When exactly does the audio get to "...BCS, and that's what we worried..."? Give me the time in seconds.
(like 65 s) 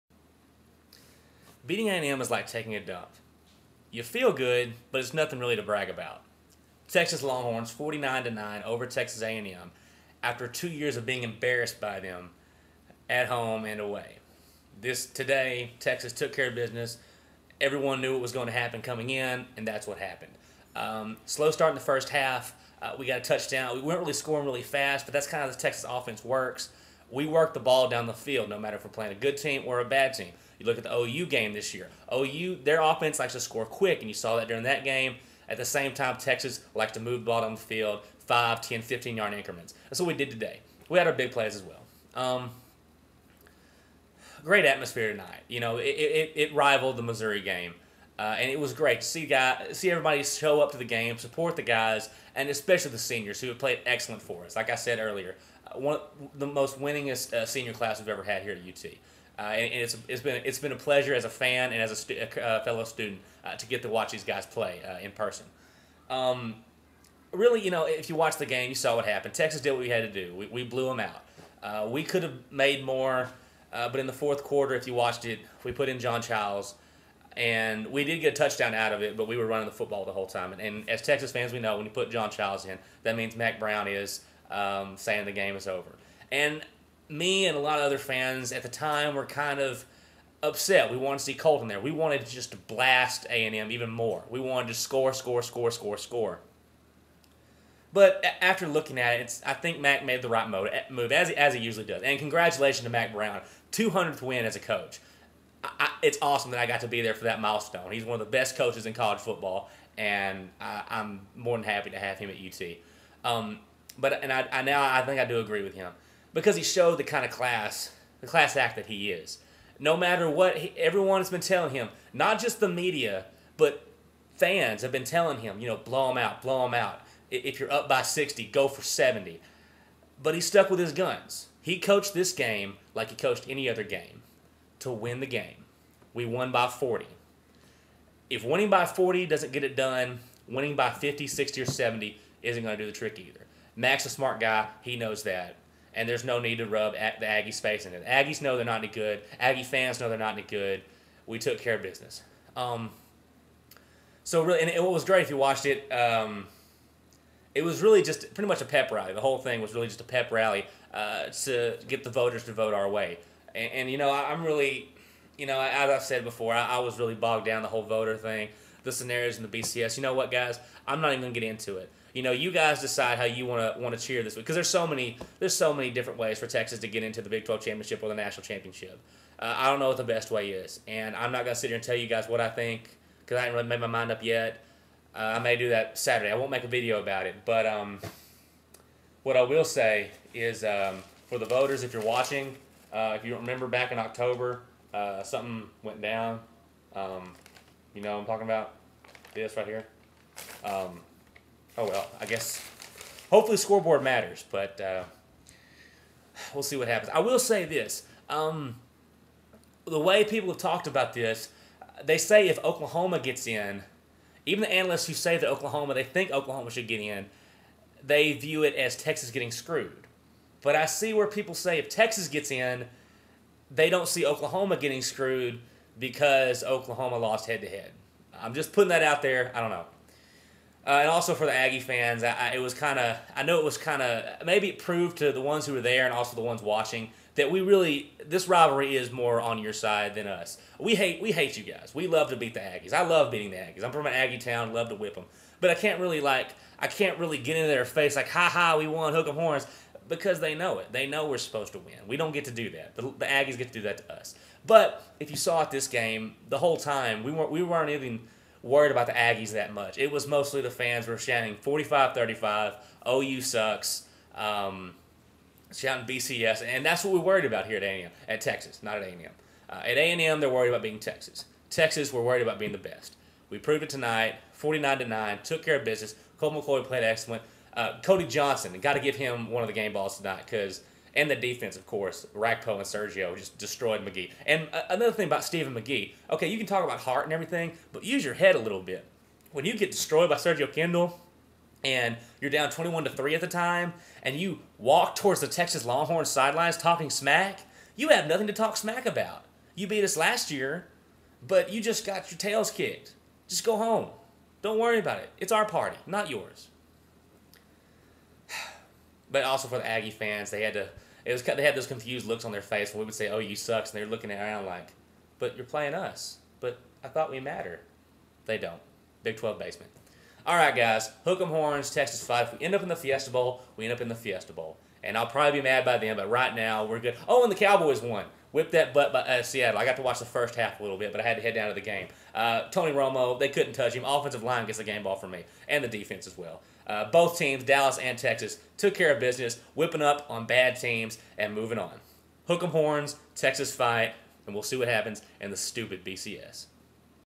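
266 s.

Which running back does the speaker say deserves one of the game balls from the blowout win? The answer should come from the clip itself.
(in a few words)
Cody Johnson.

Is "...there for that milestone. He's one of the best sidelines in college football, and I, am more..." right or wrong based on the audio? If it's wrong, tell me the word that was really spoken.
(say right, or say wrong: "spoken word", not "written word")
wrong: "coaches", not "sidelines".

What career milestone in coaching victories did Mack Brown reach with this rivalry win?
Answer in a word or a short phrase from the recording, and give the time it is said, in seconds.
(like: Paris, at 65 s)
200th win, at 103 s.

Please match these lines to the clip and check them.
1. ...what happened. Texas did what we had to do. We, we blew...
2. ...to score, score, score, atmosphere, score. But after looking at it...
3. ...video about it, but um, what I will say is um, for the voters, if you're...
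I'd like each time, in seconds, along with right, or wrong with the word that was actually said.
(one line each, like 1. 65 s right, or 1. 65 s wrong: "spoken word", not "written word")
1. 68 s right
2. 94 s wrong: "score", not "atmosphere"
3. 186 s right.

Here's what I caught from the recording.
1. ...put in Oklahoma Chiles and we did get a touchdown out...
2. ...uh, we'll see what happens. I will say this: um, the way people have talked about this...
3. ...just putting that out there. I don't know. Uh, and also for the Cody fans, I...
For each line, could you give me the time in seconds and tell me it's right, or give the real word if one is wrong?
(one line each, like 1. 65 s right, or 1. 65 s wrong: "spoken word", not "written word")
1. 75 s wrong: "John", not "Oklahoma"
2. 204 s right
3. 228 s wrong: "Aggie", not "Cody".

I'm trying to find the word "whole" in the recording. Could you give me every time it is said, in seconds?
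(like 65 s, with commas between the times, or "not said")
80 s, 159 s, 167 s, 256 s.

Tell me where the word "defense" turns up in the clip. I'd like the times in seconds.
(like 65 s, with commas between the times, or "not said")
281 s, 335 s.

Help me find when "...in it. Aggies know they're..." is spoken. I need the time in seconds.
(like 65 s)
147 s.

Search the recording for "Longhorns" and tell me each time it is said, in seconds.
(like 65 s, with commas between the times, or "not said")
7 s, 295 s.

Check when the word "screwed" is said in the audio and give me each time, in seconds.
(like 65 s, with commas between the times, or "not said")
219 s, 225 s.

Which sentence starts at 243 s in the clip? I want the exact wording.
I'm from an Aggie town, love to whip them.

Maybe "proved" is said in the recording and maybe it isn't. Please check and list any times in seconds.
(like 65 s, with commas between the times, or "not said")
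234 s, 273 s.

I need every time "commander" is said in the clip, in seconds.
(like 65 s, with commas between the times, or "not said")
not said.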